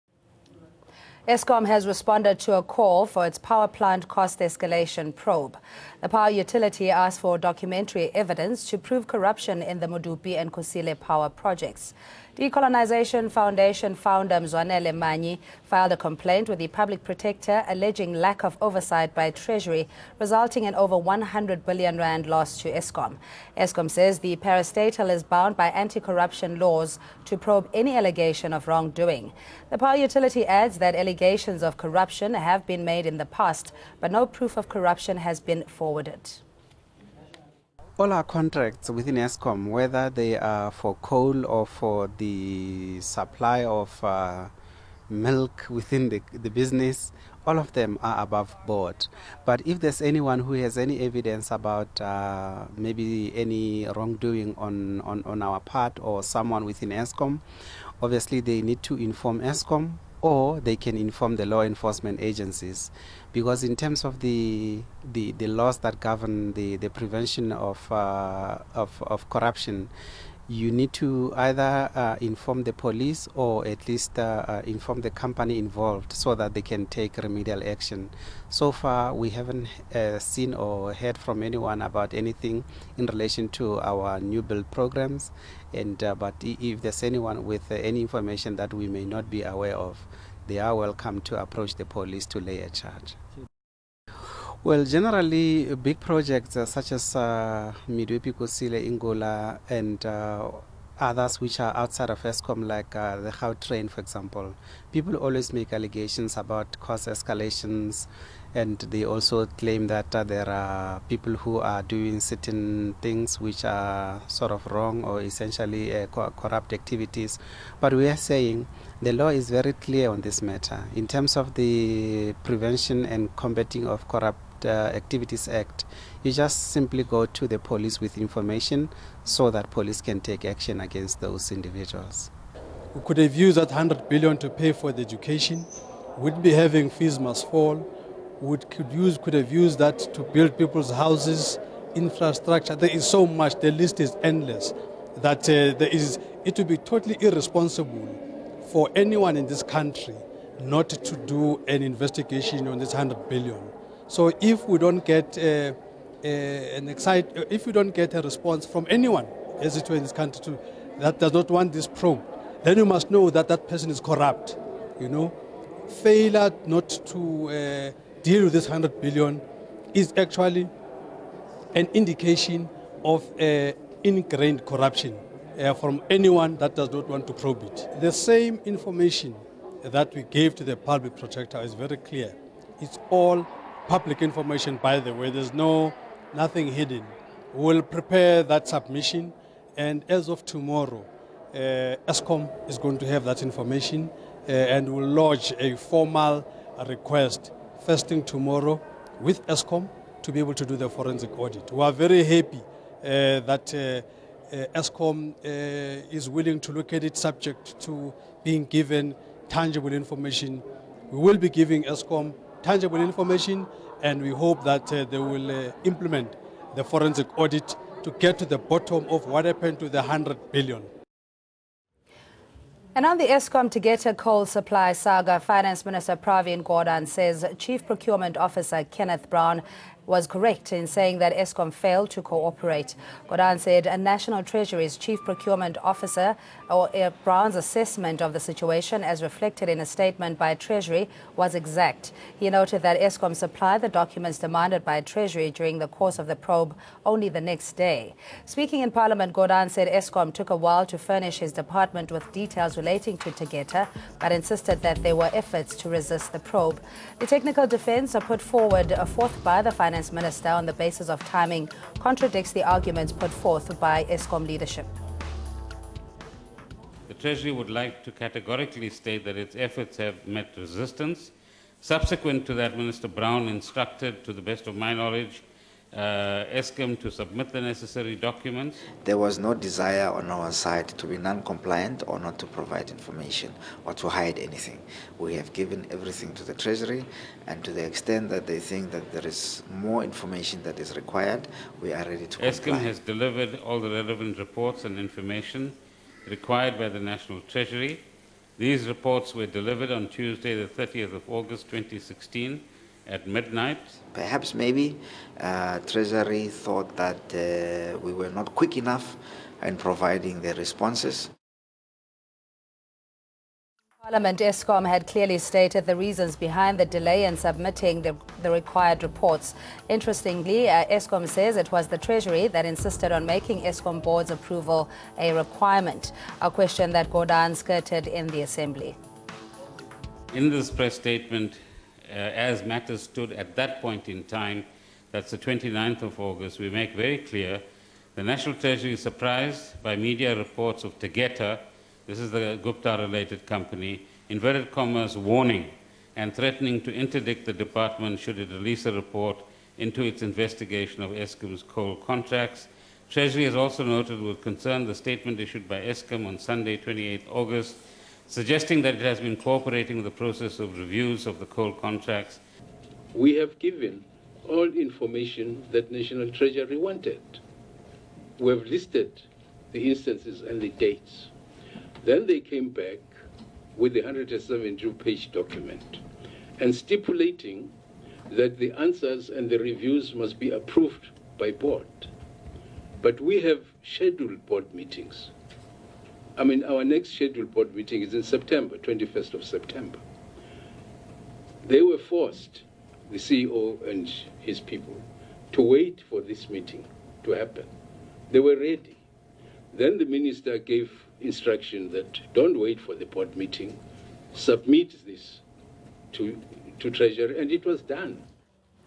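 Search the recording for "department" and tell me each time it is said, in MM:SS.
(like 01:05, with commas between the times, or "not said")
04:11, 05:47.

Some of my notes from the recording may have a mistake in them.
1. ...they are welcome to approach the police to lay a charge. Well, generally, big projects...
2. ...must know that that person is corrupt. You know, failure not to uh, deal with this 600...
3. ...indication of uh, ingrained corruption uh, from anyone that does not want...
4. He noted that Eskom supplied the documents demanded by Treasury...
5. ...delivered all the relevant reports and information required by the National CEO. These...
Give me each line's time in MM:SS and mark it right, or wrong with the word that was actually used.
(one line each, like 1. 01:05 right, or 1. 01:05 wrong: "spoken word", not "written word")
1. 01:30 right
2. 02:42 wrong: "100", not "600"
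3. 02:51 right
4. 04:02 right
5. 04:52 wrong: "Treasury", not "CEO".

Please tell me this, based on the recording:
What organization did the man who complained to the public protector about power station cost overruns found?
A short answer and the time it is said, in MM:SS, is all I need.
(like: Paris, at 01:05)
Decolonization Foundation, at 00:12.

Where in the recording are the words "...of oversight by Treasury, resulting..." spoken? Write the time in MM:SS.
00:18.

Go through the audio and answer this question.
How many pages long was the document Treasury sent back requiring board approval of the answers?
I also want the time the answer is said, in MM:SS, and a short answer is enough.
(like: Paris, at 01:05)
172, at 06:14.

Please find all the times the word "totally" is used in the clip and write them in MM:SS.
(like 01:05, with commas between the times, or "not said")
02:26.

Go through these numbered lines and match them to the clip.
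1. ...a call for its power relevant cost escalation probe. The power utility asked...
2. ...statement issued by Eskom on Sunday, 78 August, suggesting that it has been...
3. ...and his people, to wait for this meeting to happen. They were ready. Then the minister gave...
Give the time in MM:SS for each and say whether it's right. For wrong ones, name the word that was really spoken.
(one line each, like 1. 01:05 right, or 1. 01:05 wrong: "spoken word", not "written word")
1. 00:02 wrong: "plant", not "relevant"
2. 05:54 wrong: "28", not "78"
3. 06:33 right.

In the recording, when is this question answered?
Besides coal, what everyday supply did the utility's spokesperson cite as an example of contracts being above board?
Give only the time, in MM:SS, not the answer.
00:45.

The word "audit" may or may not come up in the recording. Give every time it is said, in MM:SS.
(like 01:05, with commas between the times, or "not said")
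03:21, 03:37.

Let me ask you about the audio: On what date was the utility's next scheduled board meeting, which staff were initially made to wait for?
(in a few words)
21 September.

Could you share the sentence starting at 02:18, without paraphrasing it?
We could, use, could have used that to build people's houses, infrastructure.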